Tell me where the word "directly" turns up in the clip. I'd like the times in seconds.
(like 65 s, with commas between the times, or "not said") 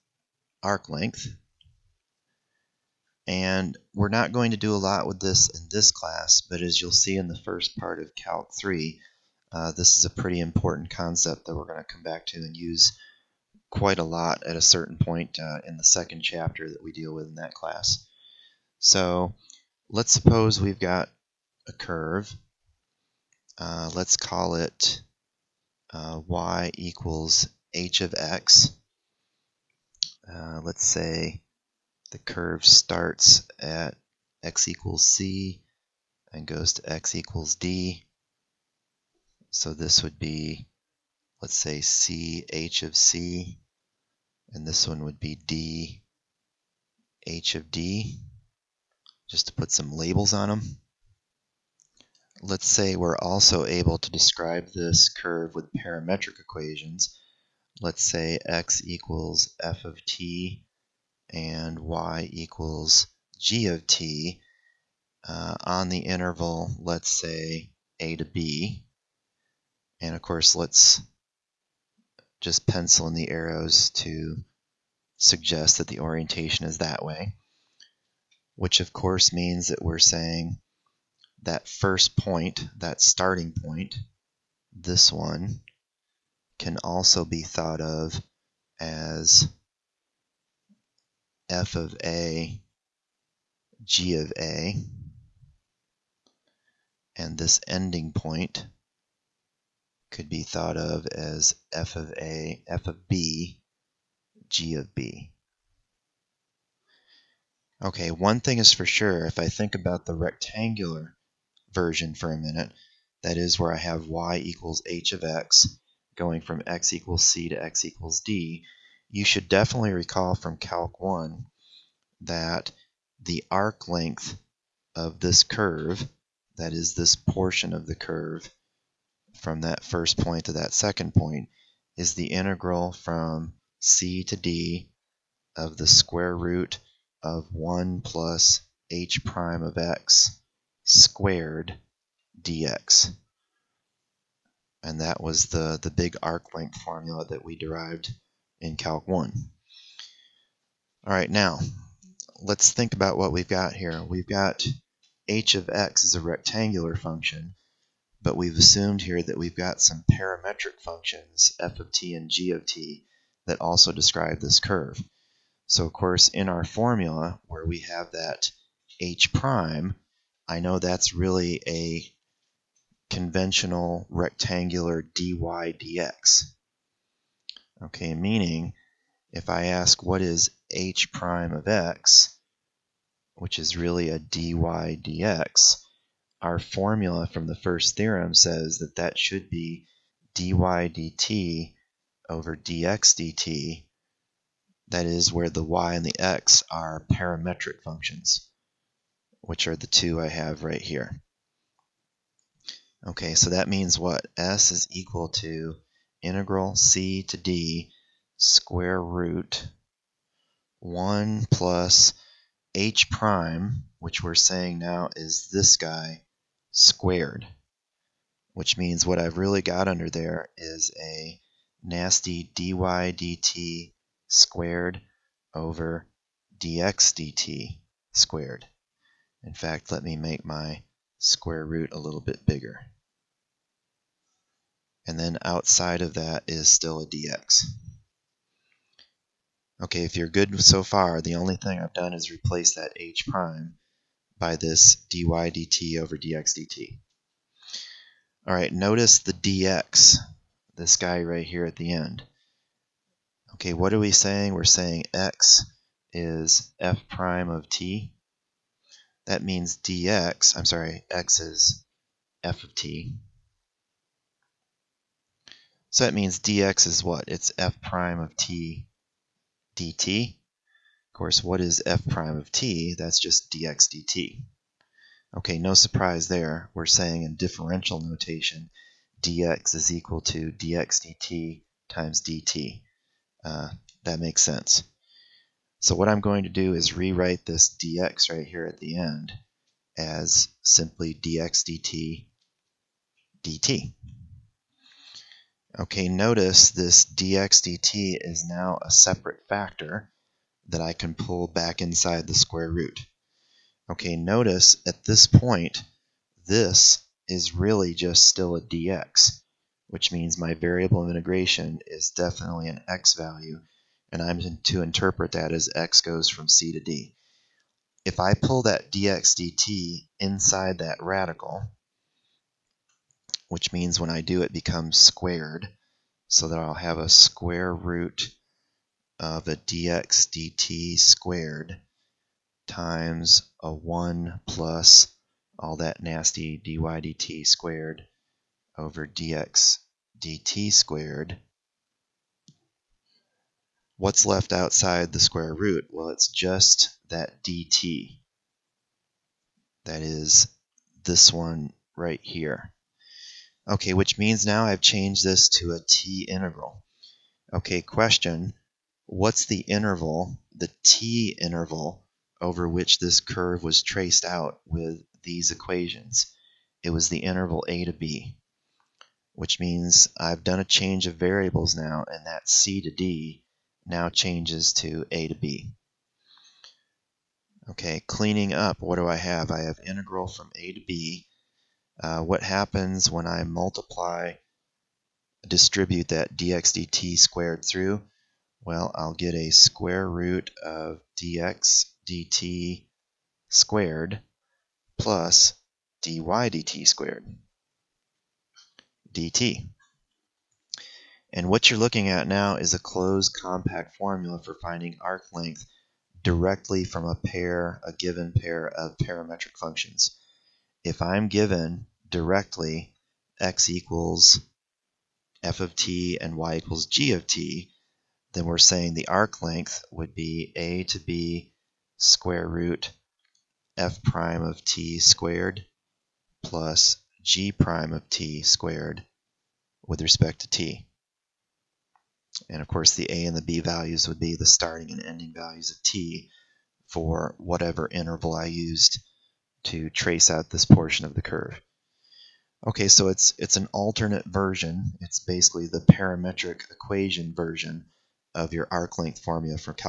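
406 s, 412 s.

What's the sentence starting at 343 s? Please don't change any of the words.
What's left outside the square root?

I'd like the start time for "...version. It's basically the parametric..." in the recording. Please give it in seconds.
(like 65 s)
444 s.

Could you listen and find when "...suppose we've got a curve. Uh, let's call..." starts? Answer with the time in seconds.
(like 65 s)
20 s.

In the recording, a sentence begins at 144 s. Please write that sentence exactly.
And that was the, the big arc length formula that we derived in Calc 1.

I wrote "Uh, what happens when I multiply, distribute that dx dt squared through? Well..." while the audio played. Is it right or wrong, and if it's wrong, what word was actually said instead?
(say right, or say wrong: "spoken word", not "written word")
right.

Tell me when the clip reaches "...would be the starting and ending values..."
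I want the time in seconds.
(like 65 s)
434 s.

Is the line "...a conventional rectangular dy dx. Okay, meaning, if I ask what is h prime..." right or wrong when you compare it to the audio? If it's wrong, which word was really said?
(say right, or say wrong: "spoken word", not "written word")
right.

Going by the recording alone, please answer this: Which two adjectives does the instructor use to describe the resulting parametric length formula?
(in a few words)
closed compact.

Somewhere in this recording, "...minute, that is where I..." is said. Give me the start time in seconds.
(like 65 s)
112 s.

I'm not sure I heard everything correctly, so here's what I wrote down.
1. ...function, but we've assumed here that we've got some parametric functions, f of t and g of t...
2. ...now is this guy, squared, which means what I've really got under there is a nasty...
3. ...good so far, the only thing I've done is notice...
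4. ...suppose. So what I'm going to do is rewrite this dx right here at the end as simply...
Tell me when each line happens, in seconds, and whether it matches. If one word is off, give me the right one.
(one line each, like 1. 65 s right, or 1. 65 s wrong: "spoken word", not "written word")
1. 156 s right
2. 214 s right
3. 240 s wrong: "replace", not "notice"
4. 284 s wrong: "sense", not "suppose".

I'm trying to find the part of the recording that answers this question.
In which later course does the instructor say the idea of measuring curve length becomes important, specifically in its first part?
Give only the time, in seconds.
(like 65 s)
8 s.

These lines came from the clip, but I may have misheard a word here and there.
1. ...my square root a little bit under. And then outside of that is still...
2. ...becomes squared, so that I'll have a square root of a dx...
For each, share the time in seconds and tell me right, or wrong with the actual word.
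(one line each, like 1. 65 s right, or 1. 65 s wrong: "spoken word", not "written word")
1. 230 s wrong: "bigger", not "under"
2. 324 s right.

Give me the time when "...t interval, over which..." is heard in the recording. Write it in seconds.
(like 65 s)
360 s.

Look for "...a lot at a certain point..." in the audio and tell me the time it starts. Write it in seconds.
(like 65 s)
13 s.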